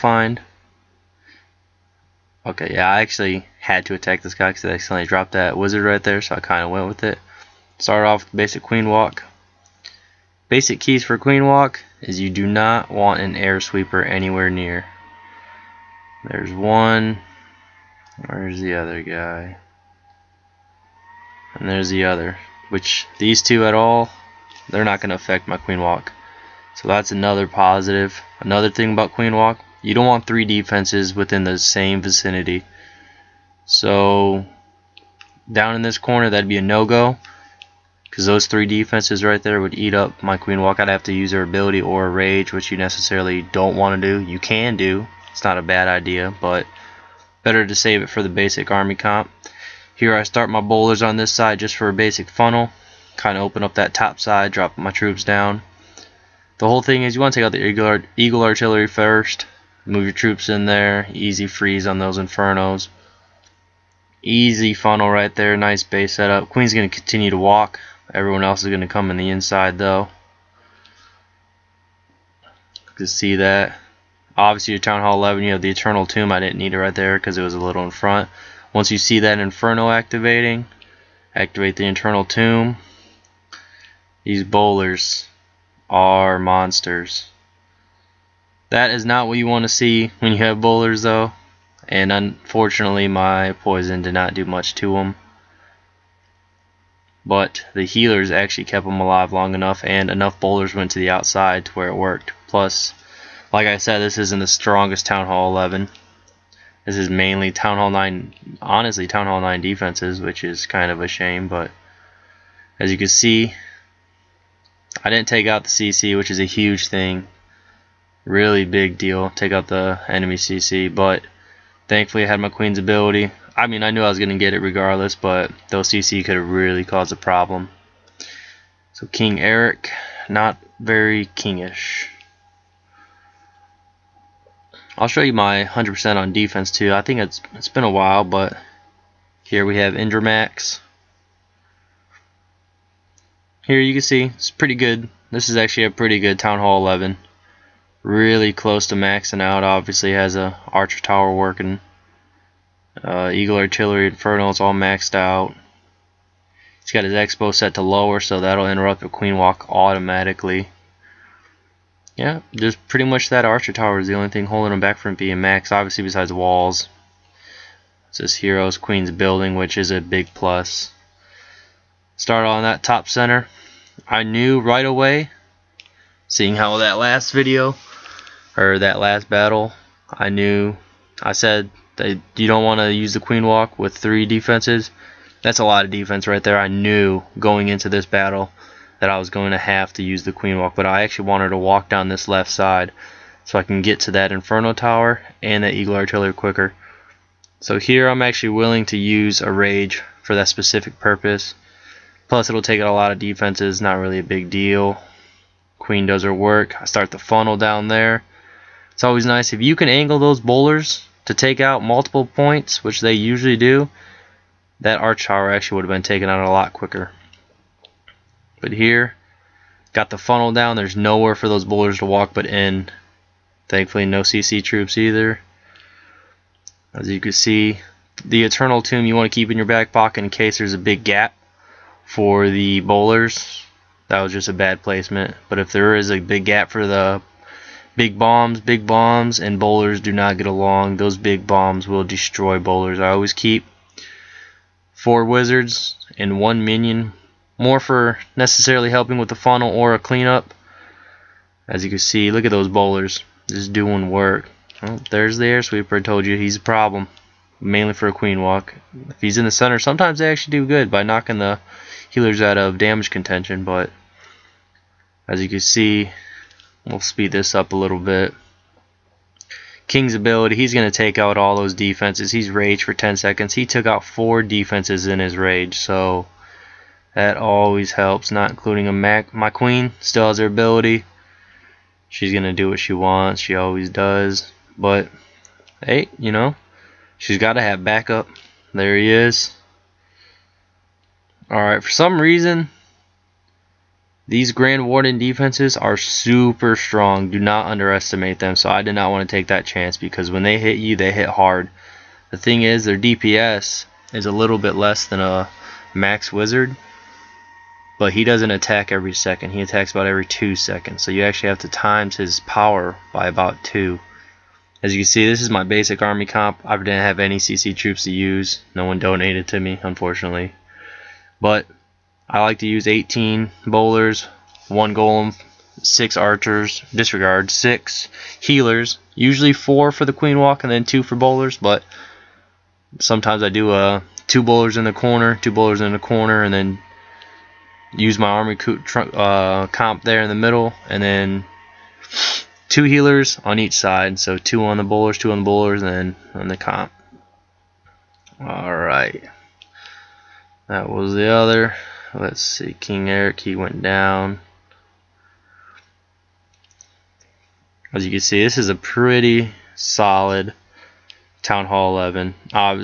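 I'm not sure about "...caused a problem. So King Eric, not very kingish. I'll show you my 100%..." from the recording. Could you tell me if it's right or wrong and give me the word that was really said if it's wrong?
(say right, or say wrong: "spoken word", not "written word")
right.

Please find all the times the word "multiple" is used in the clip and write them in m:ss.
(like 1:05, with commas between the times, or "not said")
3:31.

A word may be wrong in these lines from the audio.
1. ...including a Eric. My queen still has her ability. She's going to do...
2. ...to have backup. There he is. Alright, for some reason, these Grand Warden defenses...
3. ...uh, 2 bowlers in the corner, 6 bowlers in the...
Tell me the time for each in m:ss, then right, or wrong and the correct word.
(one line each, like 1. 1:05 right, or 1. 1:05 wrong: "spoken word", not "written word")
1. 4:38 wrong: "Mac", not "Eric"
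2. 4:47 right
3. 5:33 wrong: "2", not "6".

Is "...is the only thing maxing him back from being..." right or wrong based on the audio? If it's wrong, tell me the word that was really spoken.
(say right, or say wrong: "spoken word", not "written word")
wrong: "holding", not "maxing".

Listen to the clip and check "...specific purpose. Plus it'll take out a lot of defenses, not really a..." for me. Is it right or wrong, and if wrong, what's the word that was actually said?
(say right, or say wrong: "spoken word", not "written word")
right.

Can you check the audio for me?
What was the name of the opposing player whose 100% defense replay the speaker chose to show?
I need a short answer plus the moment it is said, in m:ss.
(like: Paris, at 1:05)
Indramax, at 2:19.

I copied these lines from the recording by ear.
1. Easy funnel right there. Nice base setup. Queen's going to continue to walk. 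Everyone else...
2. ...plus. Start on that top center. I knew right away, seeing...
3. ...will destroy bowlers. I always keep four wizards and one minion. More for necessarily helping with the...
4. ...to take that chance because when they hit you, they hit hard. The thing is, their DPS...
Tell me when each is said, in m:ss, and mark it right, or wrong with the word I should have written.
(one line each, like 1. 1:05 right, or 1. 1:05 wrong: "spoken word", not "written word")
1. 1:04 right
2. 2:50 right
3. 4:01 right
4. 4:59 right.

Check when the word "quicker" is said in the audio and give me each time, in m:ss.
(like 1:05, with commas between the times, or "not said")
3:16, 3:36.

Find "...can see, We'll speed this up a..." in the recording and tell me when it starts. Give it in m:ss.
4:25.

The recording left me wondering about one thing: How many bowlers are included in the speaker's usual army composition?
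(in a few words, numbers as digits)
18.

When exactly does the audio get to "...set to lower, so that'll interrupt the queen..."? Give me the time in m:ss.
2:37.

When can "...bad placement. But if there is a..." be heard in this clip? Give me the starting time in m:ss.
3:54.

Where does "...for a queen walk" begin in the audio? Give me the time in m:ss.
4:17.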